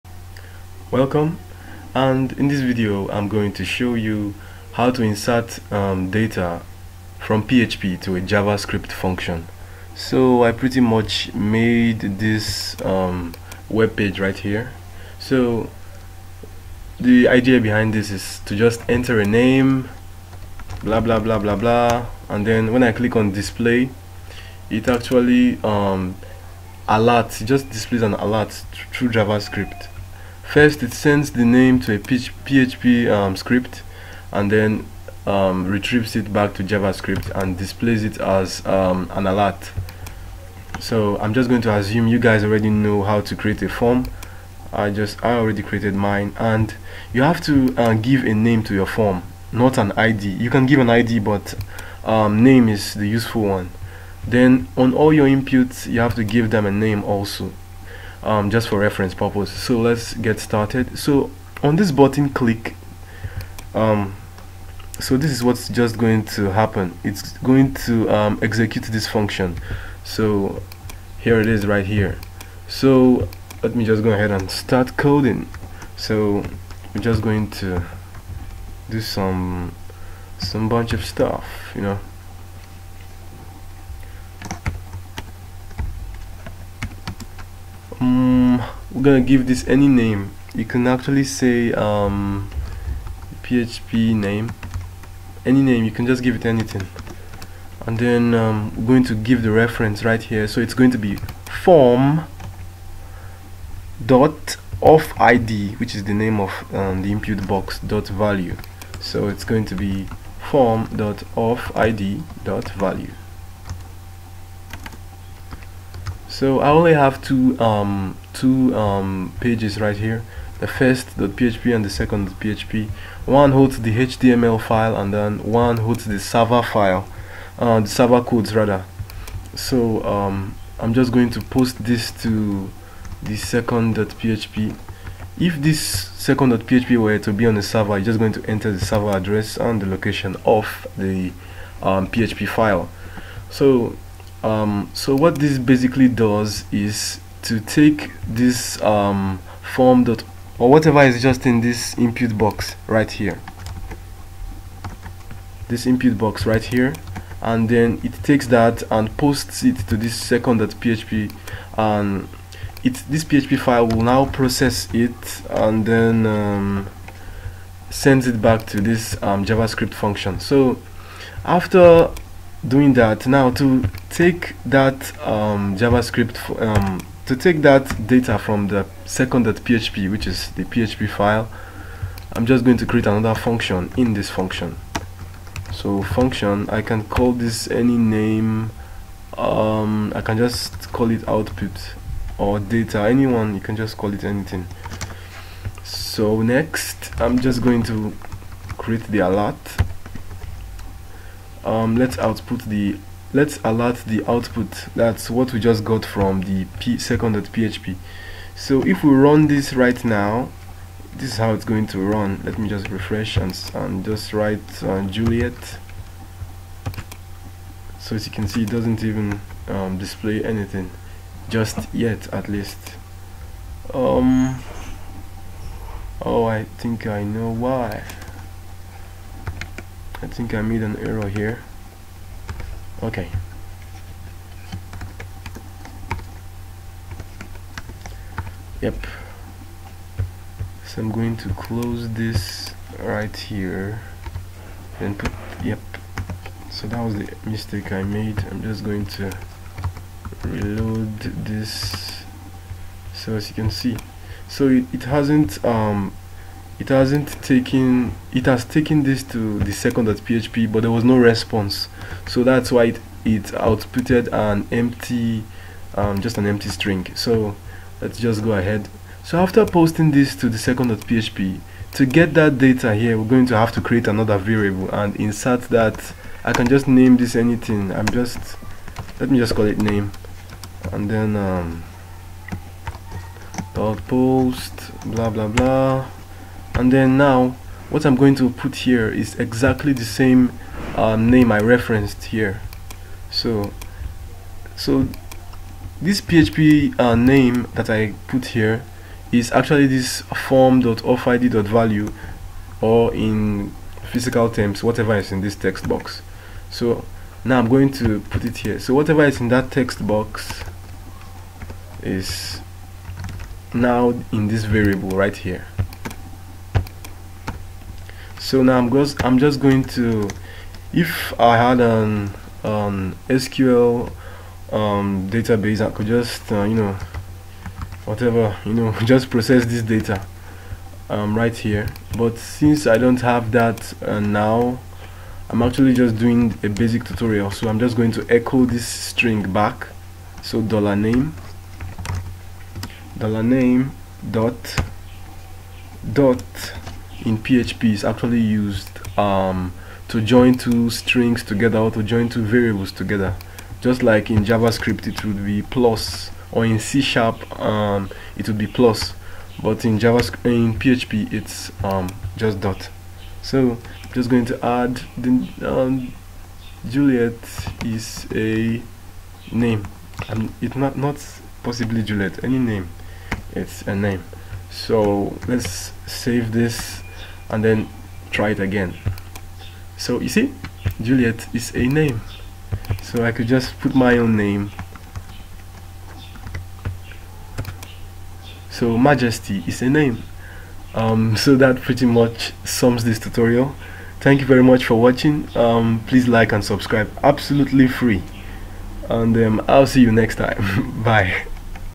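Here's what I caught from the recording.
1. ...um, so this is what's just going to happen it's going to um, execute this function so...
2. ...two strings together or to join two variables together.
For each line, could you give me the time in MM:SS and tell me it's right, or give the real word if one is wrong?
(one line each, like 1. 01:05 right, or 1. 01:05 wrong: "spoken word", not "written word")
1. 01:03 right
2. 05:50 right.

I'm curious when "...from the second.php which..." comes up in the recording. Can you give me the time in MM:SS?
02:58.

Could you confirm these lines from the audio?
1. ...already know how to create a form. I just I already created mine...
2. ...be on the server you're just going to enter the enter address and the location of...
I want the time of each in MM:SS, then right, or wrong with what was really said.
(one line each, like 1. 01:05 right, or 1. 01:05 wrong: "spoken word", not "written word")
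1. 00:42 right
2. 02:17 wrong: "server", not "enter".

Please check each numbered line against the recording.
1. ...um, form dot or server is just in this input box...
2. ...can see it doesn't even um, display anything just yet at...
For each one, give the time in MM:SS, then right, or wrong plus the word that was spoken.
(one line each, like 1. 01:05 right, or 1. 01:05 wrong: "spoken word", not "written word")
1. 02:28 wrong: "whatever", not "server"
2. 03:38 right.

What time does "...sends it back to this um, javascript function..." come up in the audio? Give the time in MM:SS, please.
02:47.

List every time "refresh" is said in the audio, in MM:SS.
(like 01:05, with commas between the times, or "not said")
03:32.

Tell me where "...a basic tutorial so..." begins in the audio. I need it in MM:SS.
05:36.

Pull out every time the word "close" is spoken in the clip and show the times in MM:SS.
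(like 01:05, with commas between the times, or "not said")
04:01.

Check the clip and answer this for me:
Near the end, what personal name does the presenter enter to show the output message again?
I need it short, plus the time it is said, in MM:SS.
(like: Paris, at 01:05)
Majesty, at 06:28.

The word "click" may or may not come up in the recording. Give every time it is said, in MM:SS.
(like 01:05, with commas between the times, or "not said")
00:22, 01:02.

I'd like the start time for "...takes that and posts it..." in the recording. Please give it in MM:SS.
02:38.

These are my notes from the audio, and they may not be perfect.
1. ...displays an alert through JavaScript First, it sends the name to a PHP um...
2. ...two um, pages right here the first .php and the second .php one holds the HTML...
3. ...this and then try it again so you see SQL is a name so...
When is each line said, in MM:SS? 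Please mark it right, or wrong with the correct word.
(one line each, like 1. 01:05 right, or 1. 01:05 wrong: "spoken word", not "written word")
1. 00:27 right
2. 01:58 right
3. 06:16 wrong: "Juliet", not "SQL".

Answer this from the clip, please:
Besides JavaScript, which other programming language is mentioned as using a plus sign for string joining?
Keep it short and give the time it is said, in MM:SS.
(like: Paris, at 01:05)
C sharp, at 05:56.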